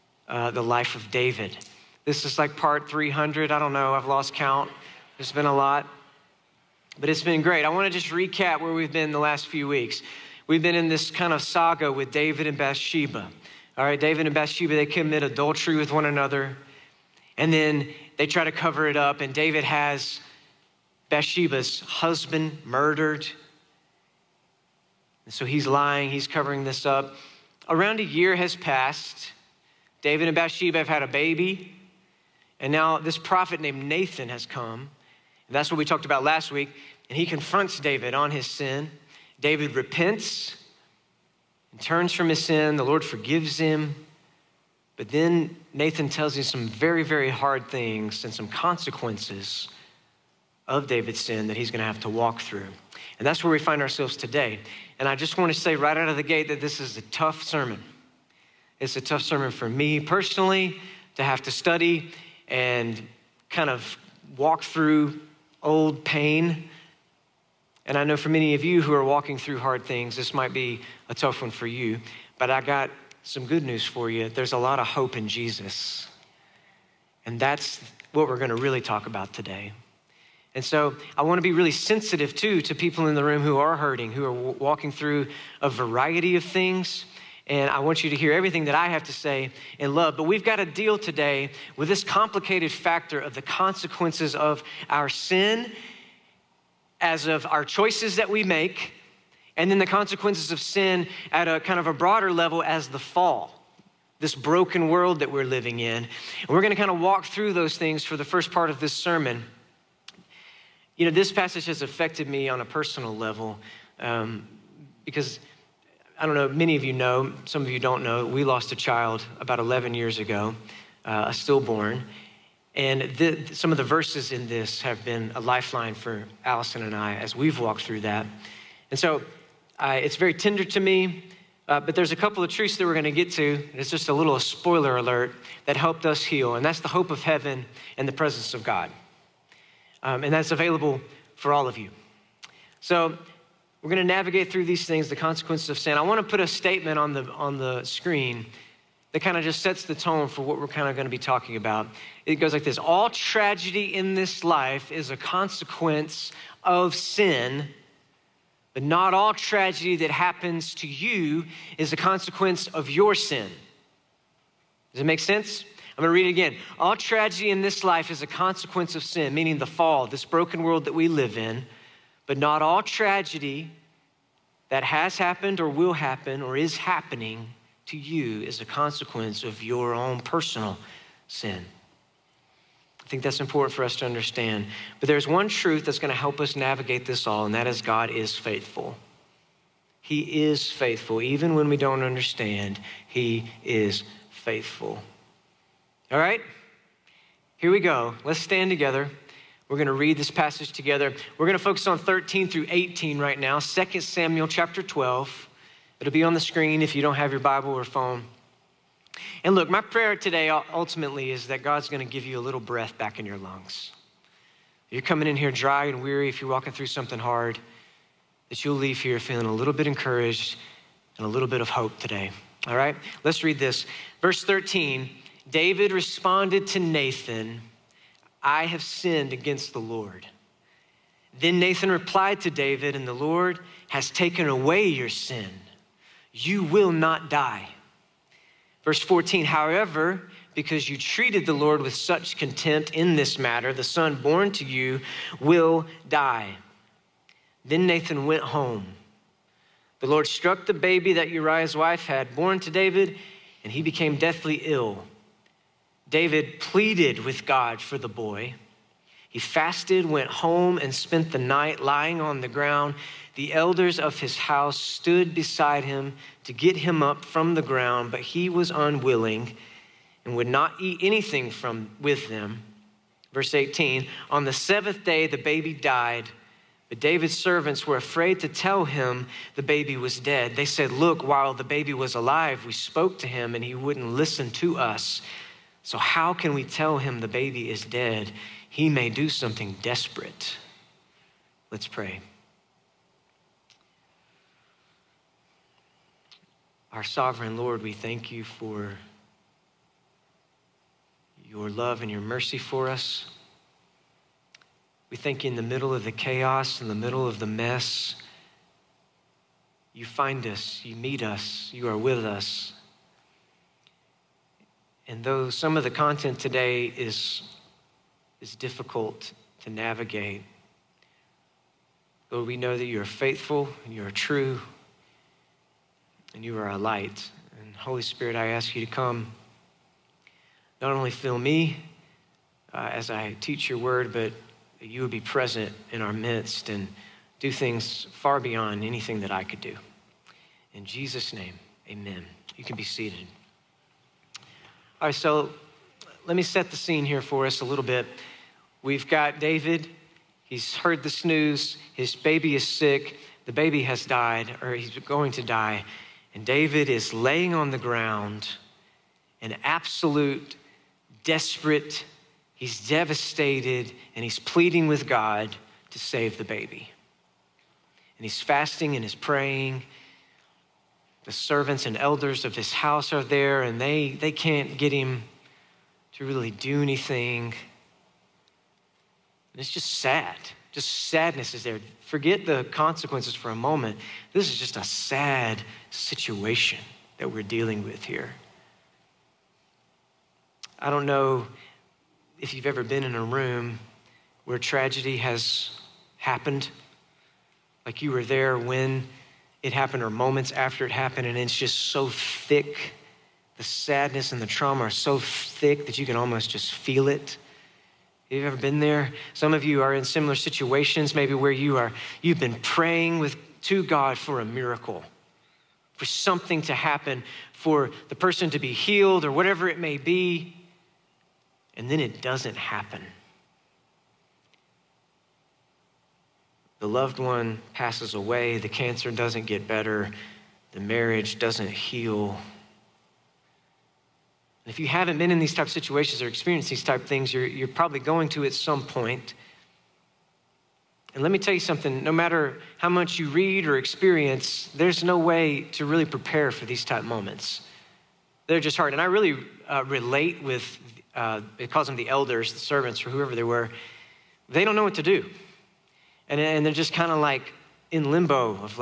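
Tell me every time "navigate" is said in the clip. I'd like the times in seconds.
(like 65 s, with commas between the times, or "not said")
144 s, 186 s, 319 s.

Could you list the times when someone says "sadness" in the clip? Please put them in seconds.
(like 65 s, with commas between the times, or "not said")
381 s, 403 s.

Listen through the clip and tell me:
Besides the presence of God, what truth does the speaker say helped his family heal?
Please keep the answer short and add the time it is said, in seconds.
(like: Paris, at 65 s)
The hope of heaven, at 136 s.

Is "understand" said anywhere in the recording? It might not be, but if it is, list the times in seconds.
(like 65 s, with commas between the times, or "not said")
184 s, 192 s.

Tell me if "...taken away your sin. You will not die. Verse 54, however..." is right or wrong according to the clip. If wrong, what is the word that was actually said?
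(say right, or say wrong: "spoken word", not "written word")
wrong: "14", not "54".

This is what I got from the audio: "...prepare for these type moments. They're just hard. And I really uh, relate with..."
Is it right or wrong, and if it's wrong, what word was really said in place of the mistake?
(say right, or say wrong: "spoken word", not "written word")
right.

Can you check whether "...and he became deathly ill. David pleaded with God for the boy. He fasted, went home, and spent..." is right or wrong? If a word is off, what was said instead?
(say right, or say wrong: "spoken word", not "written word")
right.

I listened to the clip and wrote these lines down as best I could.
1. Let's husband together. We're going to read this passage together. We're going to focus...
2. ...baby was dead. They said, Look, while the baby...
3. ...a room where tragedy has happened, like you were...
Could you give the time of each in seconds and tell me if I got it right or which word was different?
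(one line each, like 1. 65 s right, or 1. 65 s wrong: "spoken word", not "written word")
1. 198 s wrong: "stand", not "husband"
2. 279 s right
3. 393 s right.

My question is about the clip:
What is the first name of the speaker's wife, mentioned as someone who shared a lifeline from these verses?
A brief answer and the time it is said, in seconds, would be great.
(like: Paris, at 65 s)
Allison, at 126 s.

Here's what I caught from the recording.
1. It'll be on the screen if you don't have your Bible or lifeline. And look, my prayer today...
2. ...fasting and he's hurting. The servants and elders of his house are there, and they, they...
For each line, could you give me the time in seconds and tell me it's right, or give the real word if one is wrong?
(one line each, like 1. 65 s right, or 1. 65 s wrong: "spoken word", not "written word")
1. 205 s wrong: "phone", not "lifeline"
2. 368 s wrong: "praying", not "hurting".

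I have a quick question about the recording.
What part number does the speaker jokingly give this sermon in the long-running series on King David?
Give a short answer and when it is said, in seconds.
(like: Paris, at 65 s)
300, at 2 s.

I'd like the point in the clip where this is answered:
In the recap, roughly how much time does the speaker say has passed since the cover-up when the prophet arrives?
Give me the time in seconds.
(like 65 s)
27 s.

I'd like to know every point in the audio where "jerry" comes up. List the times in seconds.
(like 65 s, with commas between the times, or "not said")
not said.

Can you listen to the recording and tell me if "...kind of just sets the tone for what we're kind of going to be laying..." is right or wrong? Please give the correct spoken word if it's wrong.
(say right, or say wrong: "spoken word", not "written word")
wrong: "talking", not "laying".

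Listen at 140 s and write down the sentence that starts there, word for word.
Um, and that's available for all of you.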